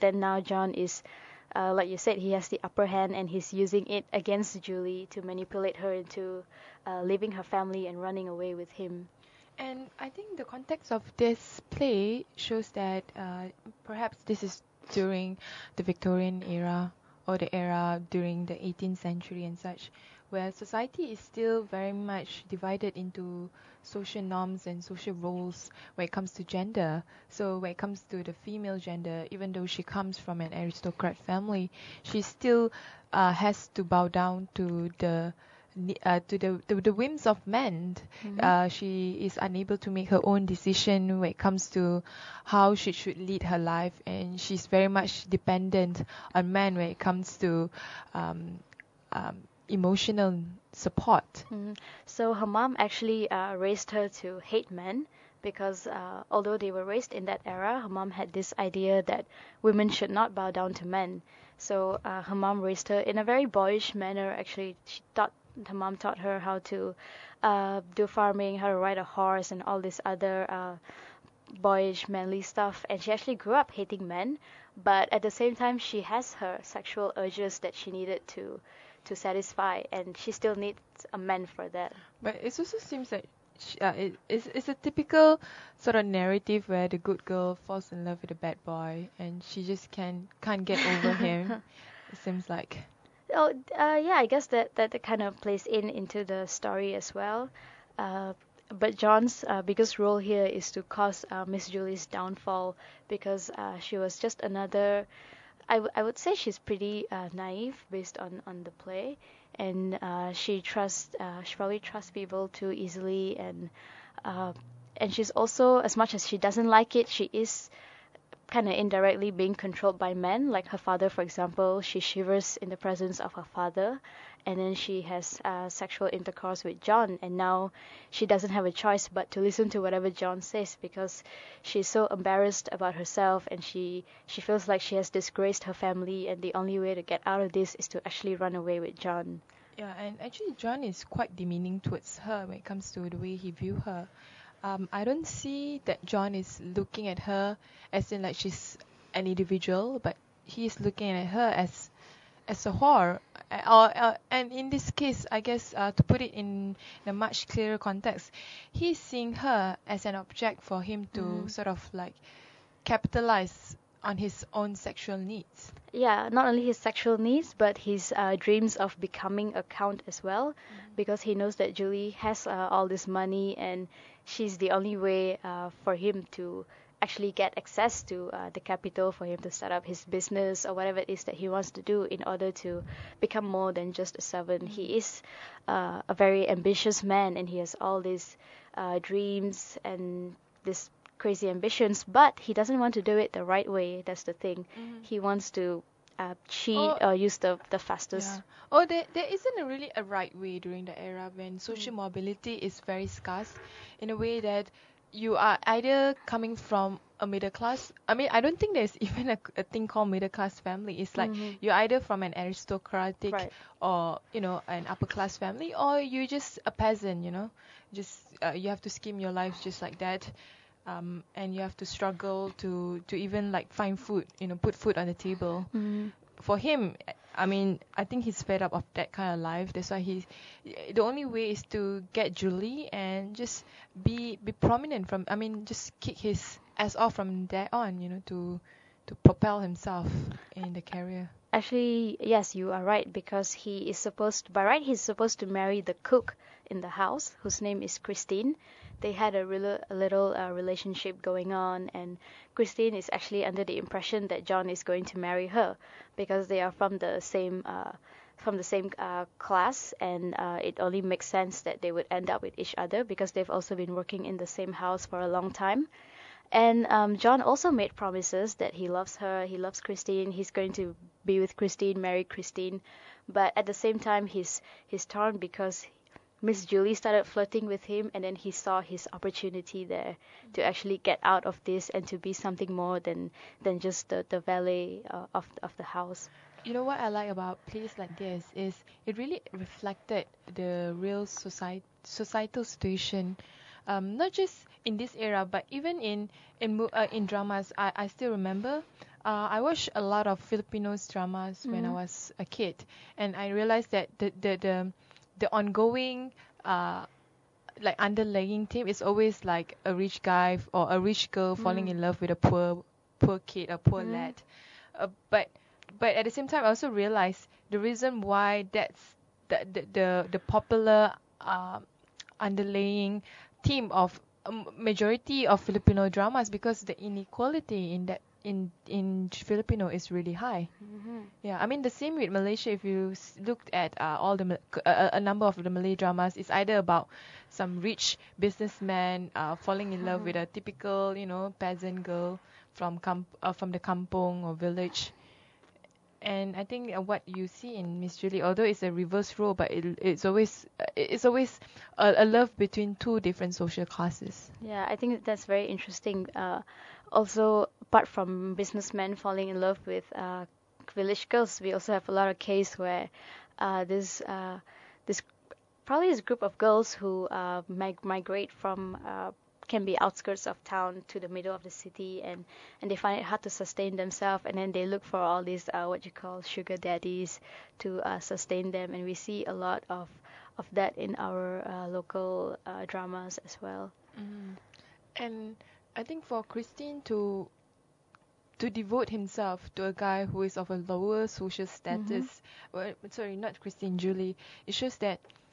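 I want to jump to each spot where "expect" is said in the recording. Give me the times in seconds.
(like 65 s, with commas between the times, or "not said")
not said.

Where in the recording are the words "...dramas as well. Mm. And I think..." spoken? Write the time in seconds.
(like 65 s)
382 s.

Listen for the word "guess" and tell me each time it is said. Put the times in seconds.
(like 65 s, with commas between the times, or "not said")
94 s, 155 s.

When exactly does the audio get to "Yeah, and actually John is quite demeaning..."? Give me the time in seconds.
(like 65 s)
139 s.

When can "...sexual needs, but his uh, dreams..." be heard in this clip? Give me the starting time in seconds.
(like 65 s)
166 s.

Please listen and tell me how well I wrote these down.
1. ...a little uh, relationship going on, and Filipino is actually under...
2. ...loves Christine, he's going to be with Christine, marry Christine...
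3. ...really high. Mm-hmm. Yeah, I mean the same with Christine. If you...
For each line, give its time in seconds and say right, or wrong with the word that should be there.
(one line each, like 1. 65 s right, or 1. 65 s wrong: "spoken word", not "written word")
1. 249 s wrong: "Christine", not "Filipino"
2. 269 s right
3. 330 s wrong: "Malaysia", not "Christine".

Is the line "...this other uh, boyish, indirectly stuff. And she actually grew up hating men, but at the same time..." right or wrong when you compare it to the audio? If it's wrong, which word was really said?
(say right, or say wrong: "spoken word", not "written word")
wrong: "manly", not "indirectly".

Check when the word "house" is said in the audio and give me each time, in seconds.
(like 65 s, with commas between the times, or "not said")
246 s, 264 s, 285 s.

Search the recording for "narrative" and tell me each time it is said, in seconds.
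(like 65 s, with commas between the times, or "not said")
86 s.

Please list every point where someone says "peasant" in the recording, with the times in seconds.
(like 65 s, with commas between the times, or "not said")
216 s, 341 s.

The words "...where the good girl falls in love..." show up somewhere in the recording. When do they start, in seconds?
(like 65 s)
86 s.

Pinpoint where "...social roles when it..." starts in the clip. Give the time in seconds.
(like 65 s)
24 s.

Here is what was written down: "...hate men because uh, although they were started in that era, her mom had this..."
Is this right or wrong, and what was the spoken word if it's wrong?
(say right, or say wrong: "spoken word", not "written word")
wrong: "raised", not "started".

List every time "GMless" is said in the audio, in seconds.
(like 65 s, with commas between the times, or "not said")
not said.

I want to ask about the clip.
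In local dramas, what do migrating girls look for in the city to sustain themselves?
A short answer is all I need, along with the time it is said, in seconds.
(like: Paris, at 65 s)
Sugar daddies, at 376 s.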